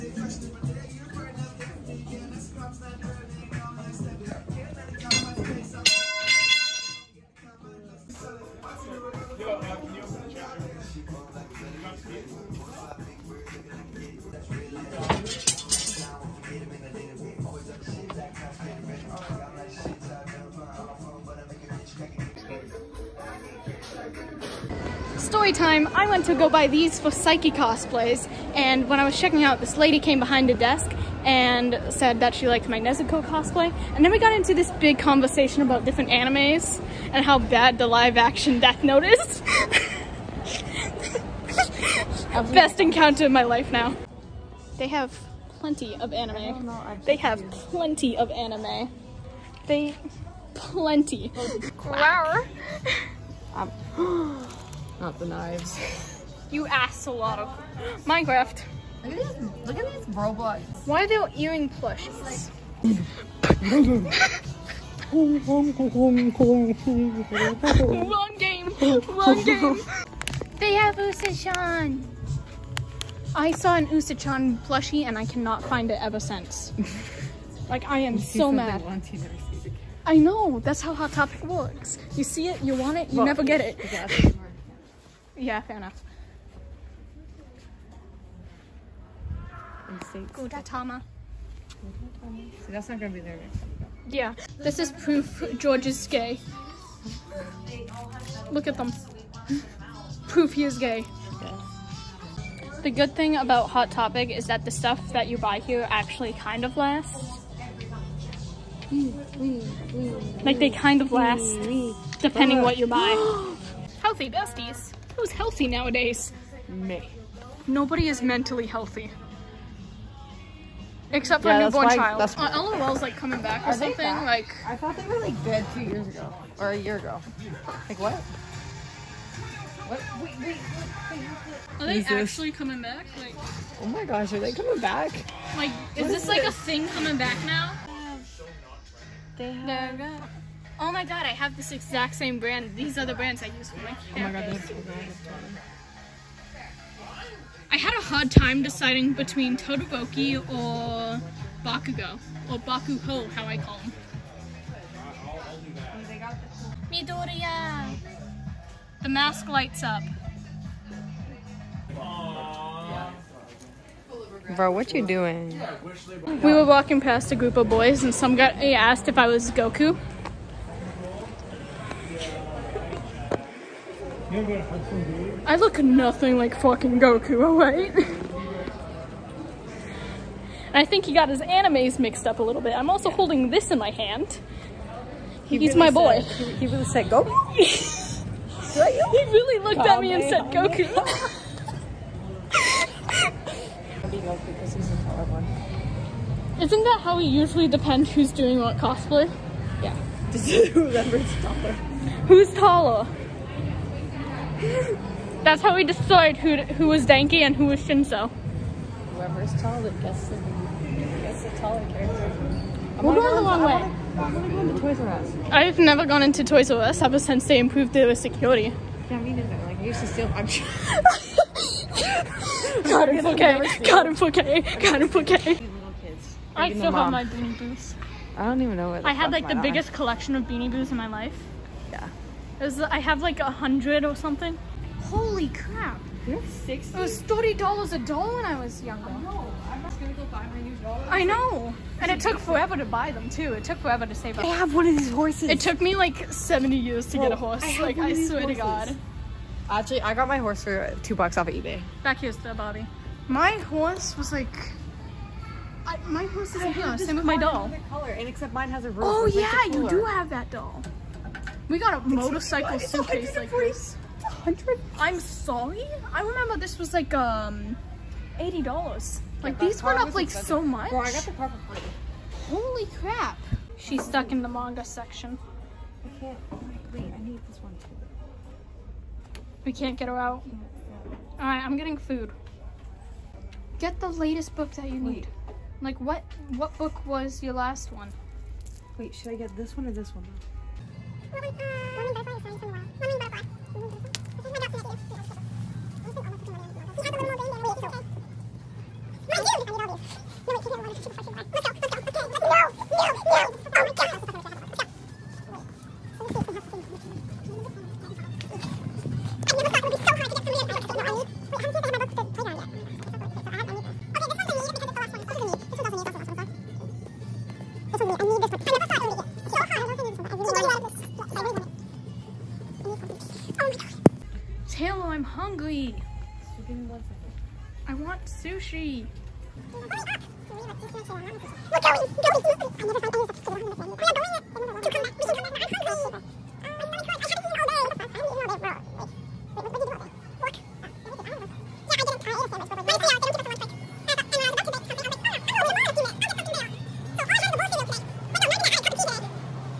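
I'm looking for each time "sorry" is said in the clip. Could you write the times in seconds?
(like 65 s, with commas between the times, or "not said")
265 s.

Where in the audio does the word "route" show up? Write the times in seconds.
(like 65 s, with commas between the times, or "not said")
not said.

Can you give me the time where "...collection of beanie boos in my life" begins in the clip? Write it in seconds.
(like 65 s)
229 s.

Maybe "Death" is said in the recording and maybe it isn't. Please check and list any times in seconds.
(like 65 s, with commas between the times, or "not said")
38 s.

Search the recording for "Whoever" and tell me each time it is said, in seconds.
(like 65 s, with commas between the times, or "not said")
200 s, 209 s.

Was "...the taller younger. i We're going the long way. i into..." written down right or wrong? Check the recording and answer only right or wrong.
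wrong.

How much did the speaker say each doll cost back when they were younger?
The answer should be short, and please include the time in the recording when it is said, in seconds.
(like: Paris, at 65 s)
$30, at 237 s.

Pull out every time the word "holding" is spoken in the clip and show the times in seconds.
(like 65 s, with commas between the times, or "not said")
183 s.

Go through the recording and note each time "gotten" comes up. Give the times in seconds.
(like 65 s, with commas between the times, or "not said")
not said.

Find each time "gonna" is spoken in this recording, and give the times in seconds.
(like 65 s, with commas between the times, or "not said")
93 s, 240 s.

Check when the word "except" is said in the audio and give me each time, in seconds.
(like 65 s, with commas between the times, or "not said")
121 s, 258 s.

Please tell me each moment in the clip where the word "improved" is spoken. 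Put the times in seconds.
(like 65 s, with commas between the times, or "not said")
217 s.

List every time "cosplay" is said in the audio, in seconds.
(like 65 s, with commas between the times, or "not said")
27 s, 33 s, 198 s.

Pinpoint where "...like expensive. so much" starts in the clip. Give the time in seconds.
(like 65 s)
270 s.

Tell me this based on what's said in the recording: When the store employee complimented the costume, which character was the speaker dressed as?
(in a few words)
Nezuko.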